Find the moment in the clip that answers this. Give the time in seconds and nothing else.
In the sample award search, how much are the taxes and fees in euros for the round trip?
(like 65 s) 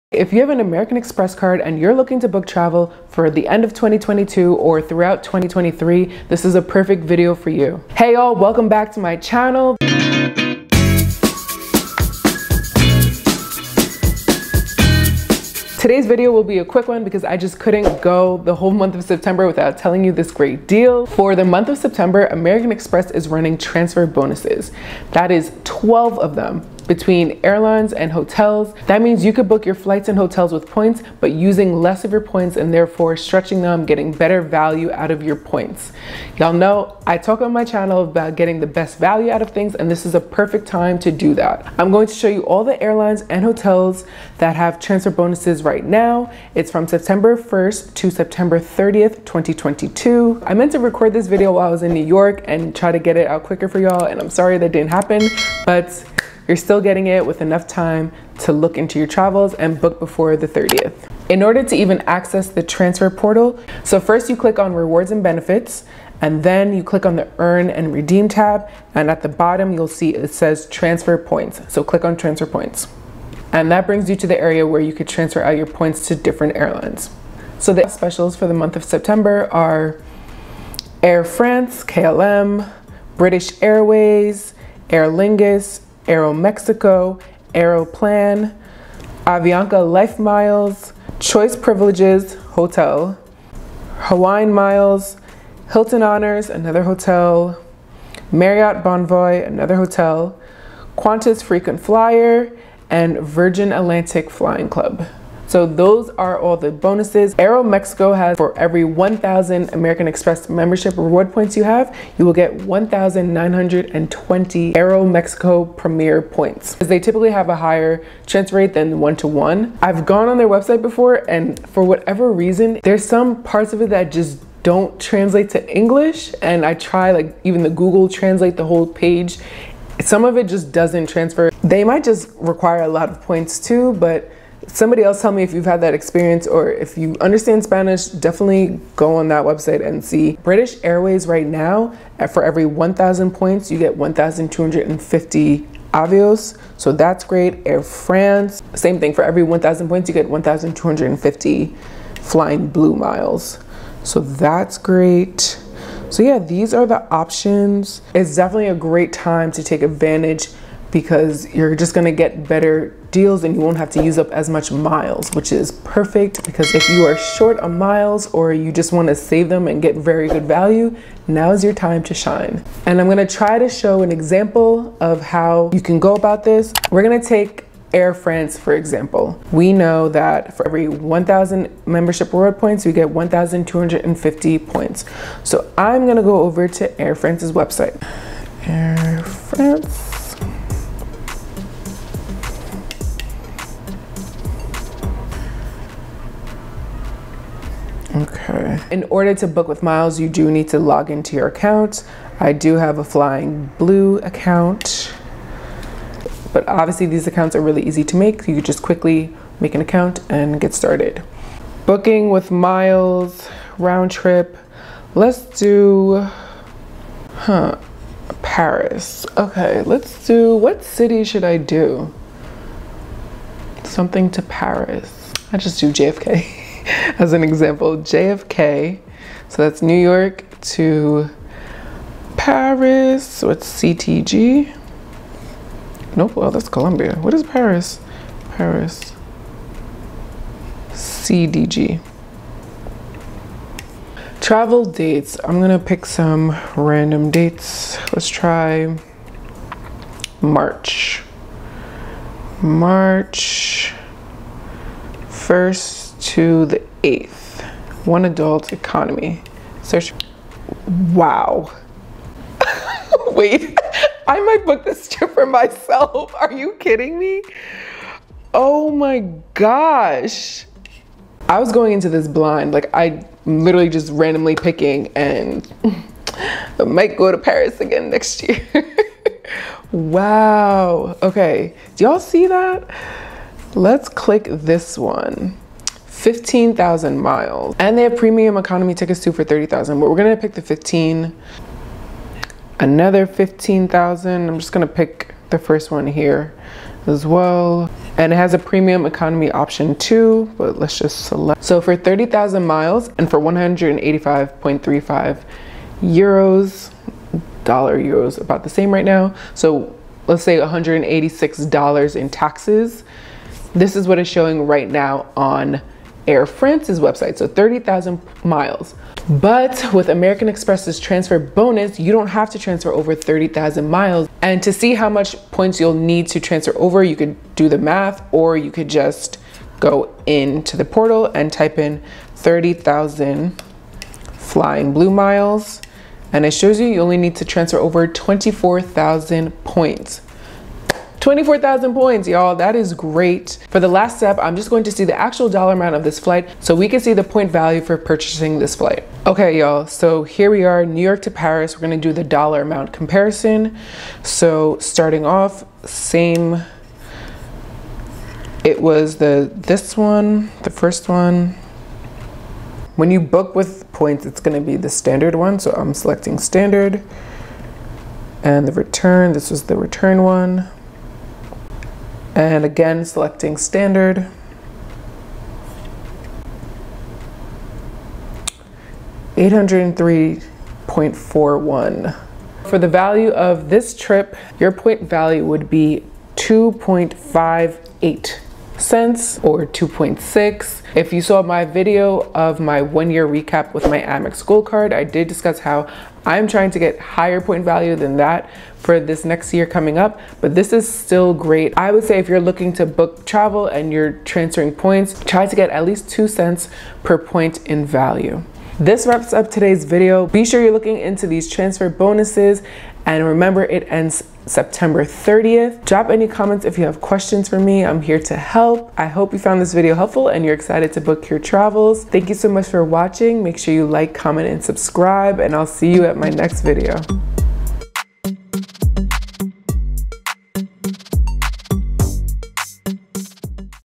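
303 s.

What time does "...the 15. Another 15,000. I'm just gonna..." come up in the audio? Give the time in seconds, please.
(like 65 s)
290 s.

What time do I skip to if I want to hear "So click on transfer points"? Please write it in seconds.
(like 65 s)
71 s.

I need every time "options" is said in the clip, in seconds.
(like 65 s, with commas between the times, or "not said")
157 s, 299 s.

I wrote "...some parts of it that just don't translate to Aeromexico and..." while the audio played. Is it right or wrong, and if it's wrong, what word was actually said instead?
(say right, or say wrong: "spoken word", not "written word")
wrong: "English", not "Aeromexico".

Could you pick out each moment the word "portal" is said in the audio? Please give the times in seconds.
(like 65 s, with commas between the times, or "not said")
63 s, 330 s.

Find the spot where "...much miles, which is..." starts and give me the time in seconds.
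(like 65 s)
164 s.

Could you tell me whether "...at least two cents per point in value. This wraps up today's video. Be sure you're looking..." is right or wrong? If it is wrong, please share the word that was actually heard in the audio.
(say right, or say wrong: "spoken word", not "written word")
right.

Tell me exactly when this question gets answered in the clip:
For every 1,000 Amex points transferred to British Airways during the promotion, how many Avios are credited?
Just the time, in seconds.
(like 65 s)
143 s.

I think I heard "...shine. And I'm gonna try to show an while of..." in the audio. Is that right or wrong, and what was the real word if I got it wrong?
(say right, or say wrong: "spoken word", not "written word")
wrong: "example", not "while".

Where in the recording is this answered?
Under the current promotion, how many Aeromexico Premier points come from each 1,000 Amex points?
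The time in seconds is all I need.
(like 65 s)
112 s.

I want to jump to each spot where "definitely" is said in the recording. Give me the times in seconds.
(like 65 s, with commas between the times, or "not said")
138 s, 158 s.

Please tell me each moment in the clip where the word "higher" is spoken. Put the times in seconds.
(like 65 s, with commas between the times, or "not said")
117 s, 396 s.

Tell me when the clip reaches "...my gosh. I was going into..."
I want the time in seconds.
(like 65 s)
268 s.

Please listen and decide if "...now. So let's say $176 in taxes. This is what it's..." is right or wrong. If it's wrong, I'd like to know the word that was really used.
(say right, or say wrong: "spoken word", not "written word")
wrong: "186", not "176".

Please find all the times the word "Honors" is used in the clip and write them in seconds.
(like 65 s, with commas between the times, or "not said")
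96 s.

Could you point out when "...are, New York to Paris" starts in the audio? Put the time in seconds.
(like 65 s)
350 s.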